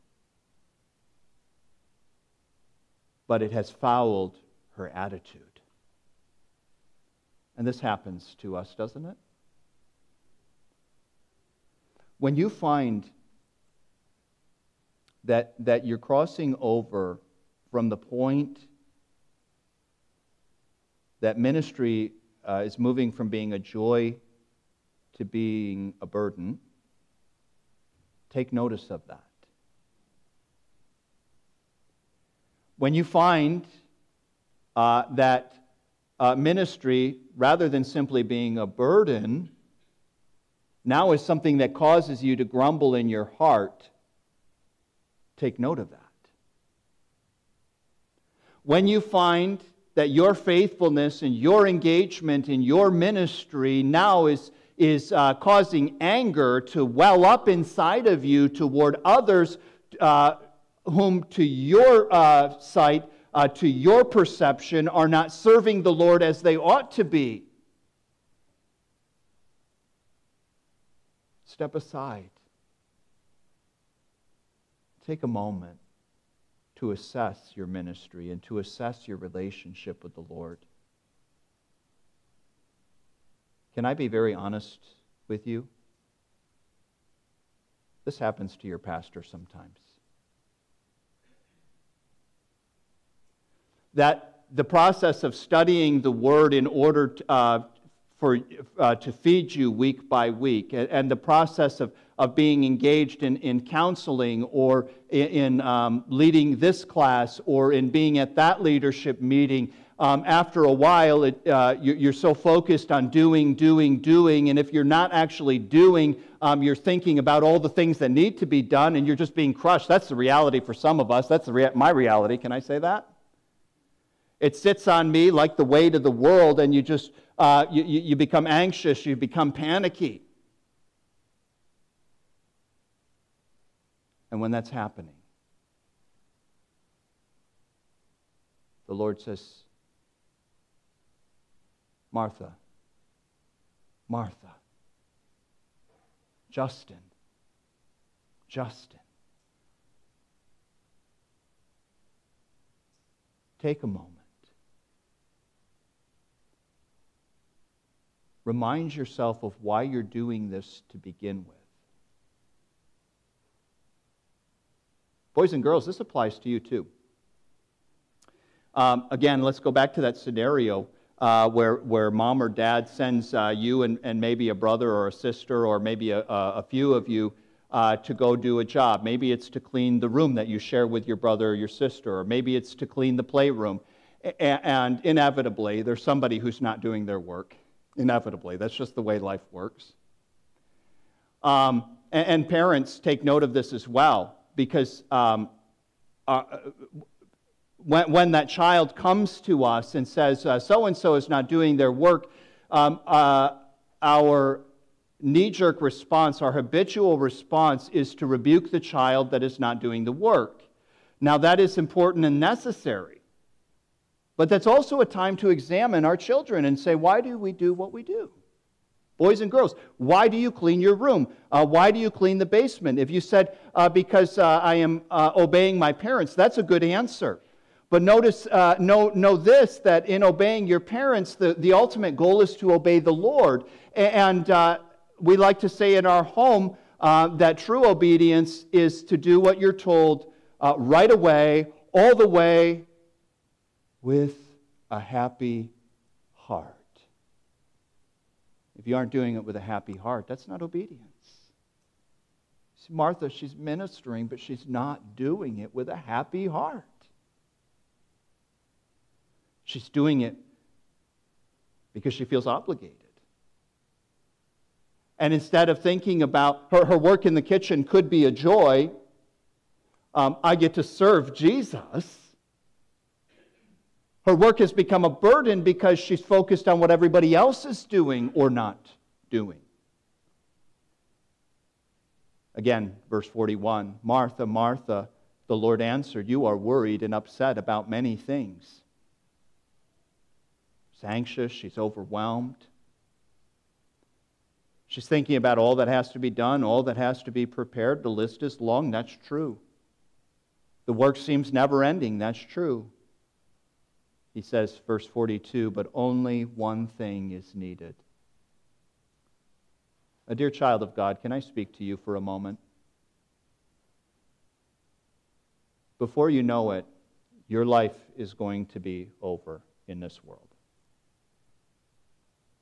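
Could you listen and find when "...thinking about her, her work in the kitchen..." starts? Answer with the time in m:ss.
4:25.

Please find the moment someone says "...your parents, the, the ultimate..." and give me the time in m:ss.
3:50.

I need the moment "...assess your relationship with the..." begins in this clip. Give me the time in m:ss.
1:18.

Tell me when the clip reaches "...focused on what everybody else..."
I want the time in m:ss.
4:36.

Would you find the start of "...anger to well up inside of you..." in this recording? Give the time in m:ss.
0:56.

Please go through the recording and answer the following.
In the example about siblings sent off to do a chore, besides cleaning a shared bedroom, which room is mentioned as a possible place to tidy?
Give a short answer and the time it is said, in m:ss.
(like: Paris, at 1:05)
the playroom, at 3:03.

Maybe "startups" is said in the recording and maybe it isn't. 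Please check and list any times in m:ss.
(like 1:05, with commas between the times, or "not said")
not said.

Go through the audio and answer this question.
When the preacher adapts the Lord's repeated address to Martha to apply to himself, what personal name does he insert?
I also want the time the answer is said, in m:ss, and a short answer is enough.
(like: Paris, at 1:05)
Justin, at 2:26.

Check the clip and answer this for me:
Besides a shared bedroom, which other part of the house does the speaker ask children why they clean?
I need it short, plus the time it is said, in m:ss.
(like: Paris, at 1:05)
the basement, at 3:42.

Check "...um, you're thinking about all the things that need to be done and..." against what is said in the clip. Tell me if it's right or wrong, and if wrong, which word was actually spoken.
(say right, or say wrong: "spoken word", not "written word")
right.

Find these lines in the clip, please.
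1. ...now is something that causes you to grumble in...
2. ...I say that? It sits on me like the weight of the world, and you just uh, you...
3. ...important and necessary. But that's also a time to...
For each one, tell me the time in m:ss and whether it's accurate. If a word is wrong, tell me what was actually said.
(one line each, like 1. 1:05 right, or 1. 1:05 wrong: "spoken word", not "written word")
1. 0:40 right
2. 2:02 right
3. 3:31 right.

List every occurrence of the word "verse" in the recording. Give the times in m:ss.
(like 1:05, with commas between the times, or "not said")
4:43, 5:04.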